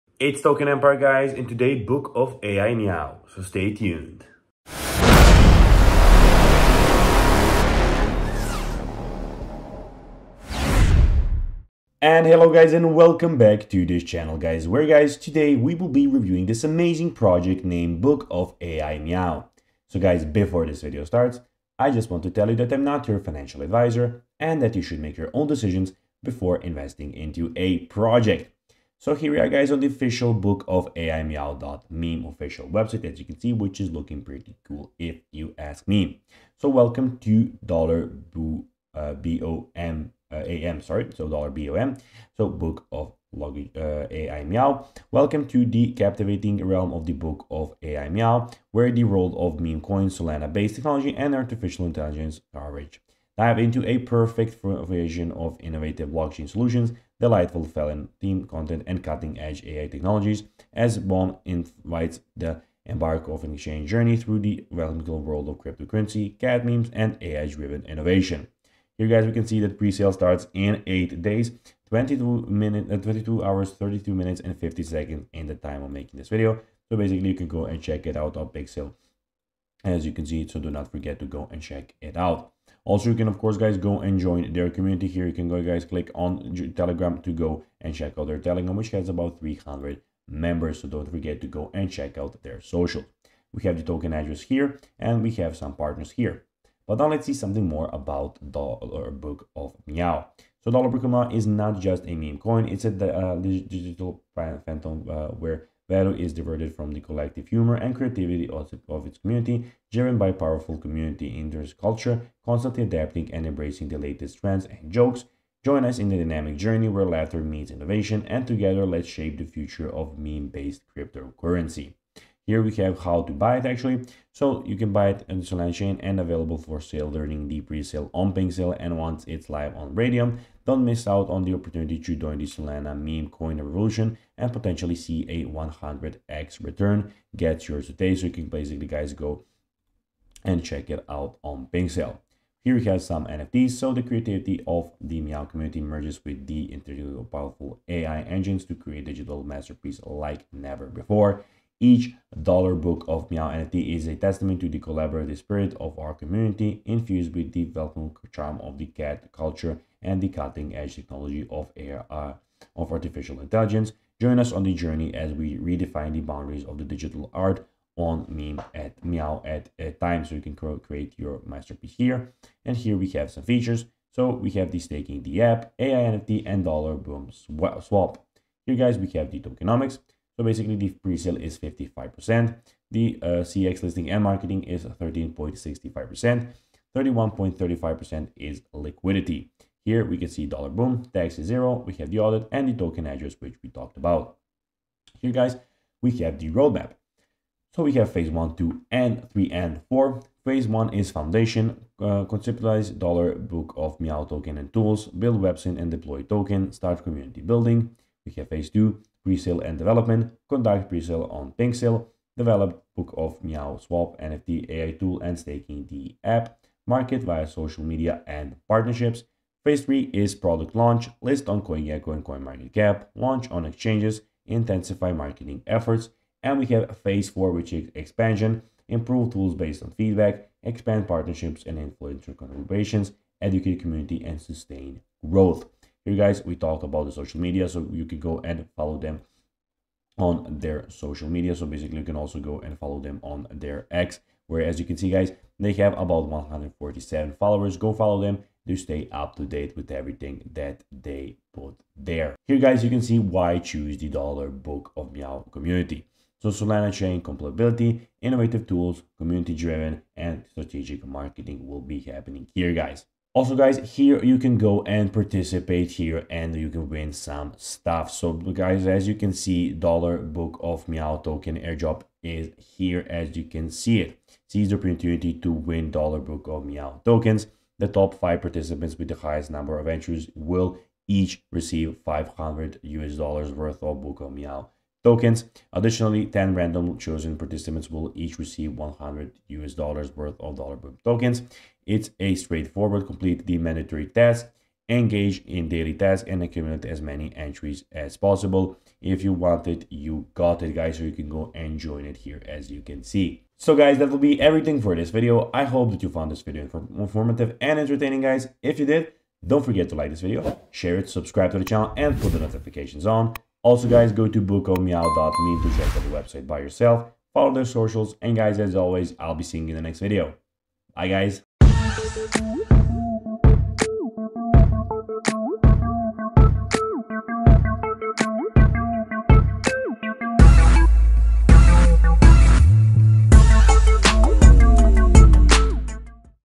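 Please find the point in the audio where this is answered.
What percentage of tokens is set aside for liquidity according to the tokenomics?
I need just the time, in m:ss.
3:06.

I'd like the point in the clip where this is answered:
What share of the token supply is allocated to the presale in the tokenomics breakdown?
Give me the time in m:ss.
3:01.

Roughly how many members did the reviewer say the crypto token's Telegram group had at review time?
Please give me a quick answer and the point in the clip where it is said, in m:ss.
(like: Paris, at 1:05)
300, at 1:29.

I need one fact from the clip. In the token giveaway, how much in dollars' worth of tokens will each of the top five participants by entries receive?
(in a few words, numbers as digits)
$500.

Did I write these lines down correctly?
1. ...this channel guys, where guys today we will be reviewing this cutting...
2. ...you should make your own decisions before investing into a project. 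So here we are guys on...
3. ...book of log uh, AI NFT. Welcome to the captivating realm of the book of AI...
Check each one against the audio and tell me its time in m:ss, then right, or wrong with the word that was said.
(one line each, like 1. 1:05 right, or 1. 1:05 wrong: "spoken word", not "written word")
1. 0:13 wrong: "amazing", not "cutting"
2. 0:24 right
3. 0:42 wrong: "Meow", not "NFT".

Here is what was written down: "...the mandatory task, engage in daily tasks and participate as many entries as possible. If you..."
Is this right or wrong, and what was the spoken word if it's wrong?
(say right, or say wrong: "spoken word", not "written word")
wrong: "accumulate", not "participate".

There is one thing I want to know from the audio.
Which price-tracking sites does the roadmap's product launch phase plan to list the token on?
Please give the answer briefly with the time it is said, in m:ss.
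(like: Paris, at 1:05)
CoinGecko and CoinMarketCap, at 3:41.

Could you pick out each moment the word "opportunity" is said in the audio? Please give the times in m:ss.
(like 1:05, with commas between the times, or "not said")
2:11, 4:34.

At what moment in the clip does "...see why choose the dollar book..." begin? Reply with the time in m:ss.
4:13.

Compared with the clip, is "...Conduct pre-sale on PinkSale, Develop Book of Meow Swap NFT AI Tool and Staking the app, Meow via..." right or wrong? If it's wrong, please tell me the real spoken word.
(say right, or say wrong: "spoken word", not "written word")
wrong: "Market", not "Meow".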